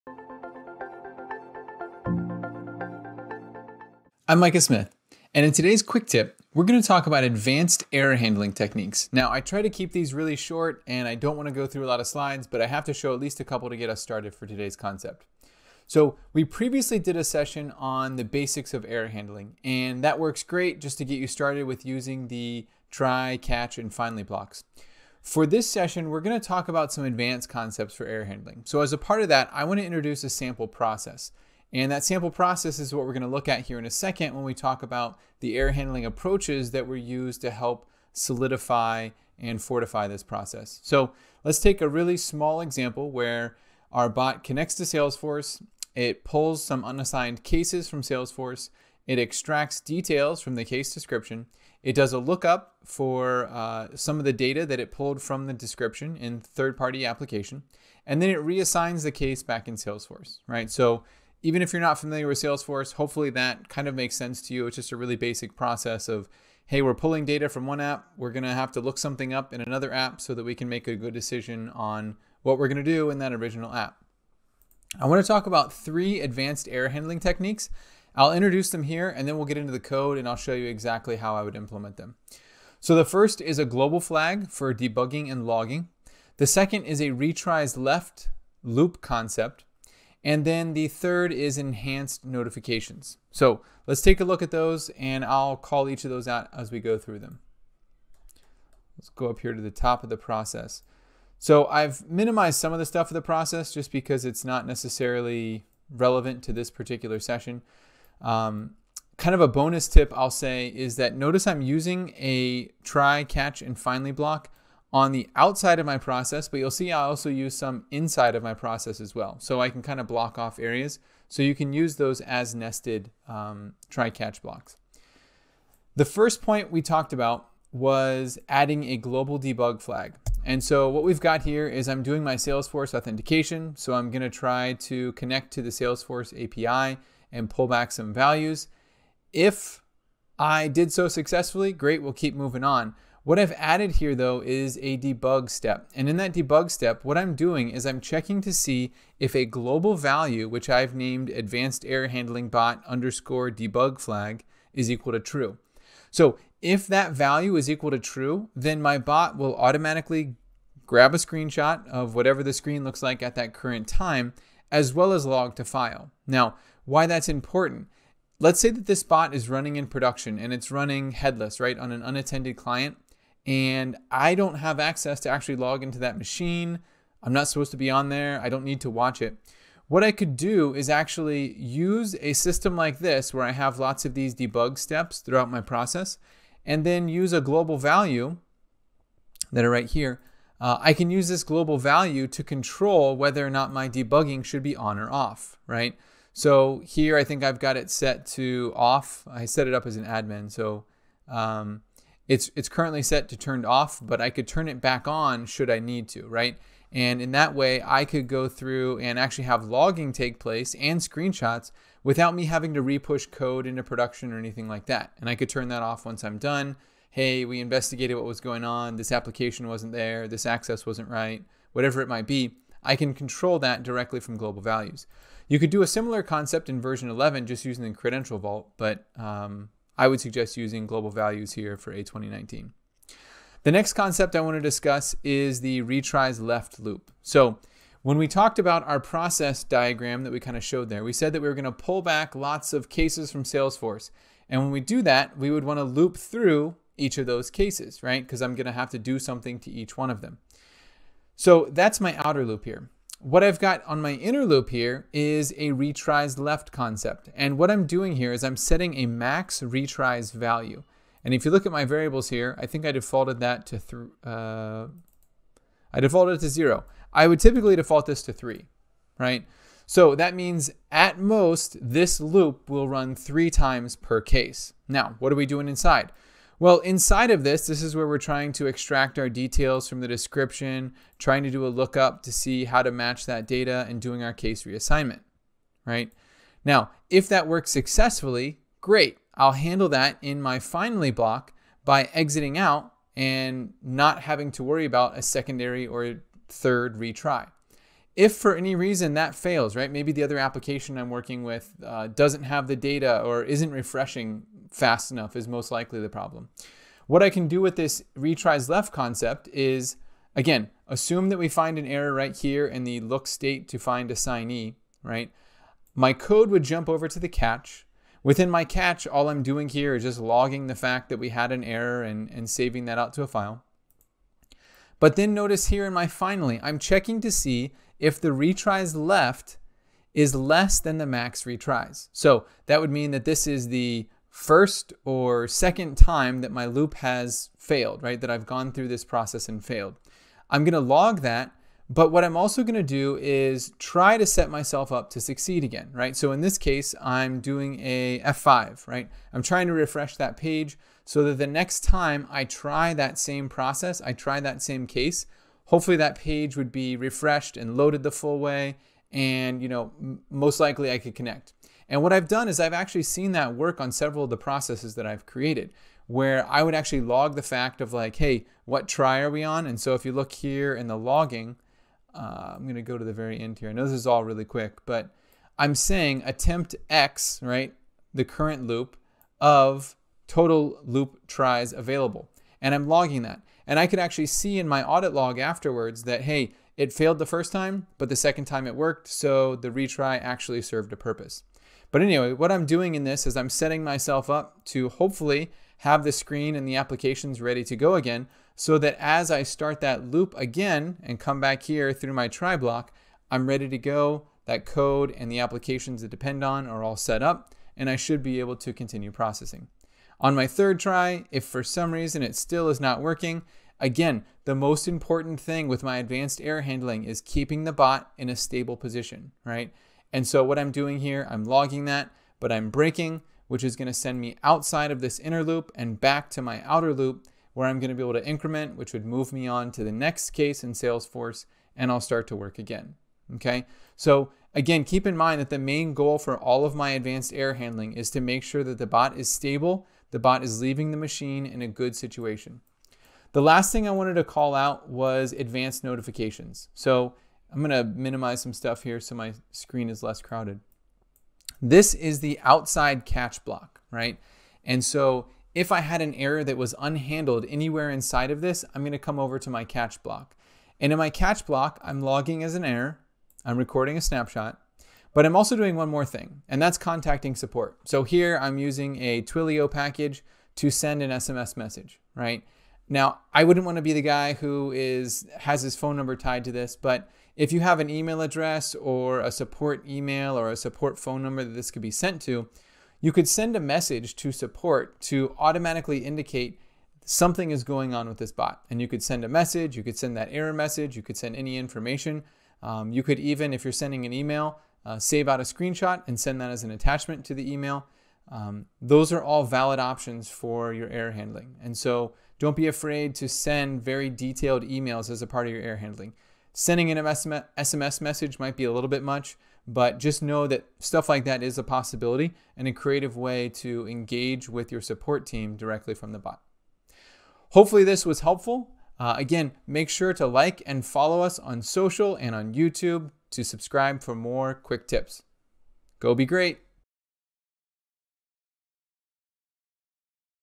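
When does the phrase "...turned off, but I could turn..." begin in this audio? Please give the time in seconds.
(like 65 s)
203 s.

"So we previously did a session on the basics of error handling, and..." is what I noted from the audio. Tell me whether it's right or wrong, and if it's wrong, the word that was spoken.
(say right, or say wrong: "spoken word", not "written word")
right.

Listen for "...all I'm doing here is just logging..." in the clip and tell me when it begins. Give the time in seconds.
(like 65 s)
319 s.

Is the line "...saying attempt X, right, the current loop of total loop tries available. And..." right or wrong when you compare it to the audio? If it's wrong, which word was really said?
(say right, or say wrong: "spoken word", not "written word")
right.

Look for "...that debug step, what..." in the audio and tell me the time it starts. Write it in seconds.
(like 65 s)
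146 s.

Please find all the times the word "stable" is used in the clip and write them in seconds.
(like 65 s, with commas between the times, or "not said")
418 s, 439 s.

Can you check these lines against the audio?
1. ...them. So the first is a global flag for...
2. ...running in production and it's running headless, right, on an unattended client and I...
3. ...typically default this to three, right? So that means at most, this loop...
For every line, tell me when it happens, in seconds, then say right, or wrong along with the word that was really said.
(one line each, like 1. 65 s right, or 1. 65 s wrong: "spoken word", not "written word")
1. 81 s right
2. 169 s right
3. 267 s right.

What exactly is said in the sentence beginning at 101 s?
So I've minimized some of the stuff of the process just because it's not necessarily relevant to this particular session.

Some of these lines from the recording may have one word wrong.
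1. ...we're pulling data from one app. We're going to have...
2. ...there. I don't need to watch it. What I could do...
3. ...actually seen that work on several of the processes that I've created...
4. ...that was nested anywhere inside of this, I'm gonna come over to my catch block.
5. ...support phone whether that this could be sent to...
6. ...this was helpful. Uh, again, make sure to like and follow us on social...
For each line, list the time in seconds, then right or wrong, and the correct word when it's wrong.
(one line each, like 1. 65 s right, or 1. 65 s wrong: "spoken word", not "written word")
1. 66 s right
2. 178 s right
3. 362 s right
4. 456 s wrong: "unhandled", not "nested"
5. 480 s wrong: "number", not "whether"
6. 517 s right.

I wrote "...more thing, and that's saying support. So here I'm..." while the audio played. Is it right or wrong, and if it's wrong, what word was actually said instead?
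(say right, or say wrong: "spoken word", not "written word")
wrong: "contacting", not "saying".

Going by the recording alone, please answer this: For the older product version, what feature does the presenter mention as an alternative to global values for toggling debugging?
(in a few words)
credential vault.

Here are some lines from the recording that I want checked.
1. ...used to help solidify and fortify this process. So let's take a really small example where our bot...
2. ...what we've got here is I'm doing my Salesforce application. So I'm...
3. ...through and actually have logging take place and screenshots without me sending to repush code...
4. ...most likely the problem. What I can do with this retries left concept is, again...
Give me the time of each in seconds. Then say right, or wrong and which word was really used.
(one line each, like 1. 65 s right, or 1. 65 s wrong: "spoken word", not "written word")
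1. 36 s right
2. 130 s wrong: "authentication", not "application"
3. 208 s wrong: "having", not "sending"
4. 305 s right.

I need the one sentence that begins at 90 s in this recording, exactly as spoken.
And then the third is enhanced notifications.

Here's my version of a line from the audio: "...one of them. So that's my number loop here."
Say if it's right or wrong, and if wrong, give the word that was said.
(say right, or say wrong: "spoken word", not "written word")
wrong: "outer", not "number".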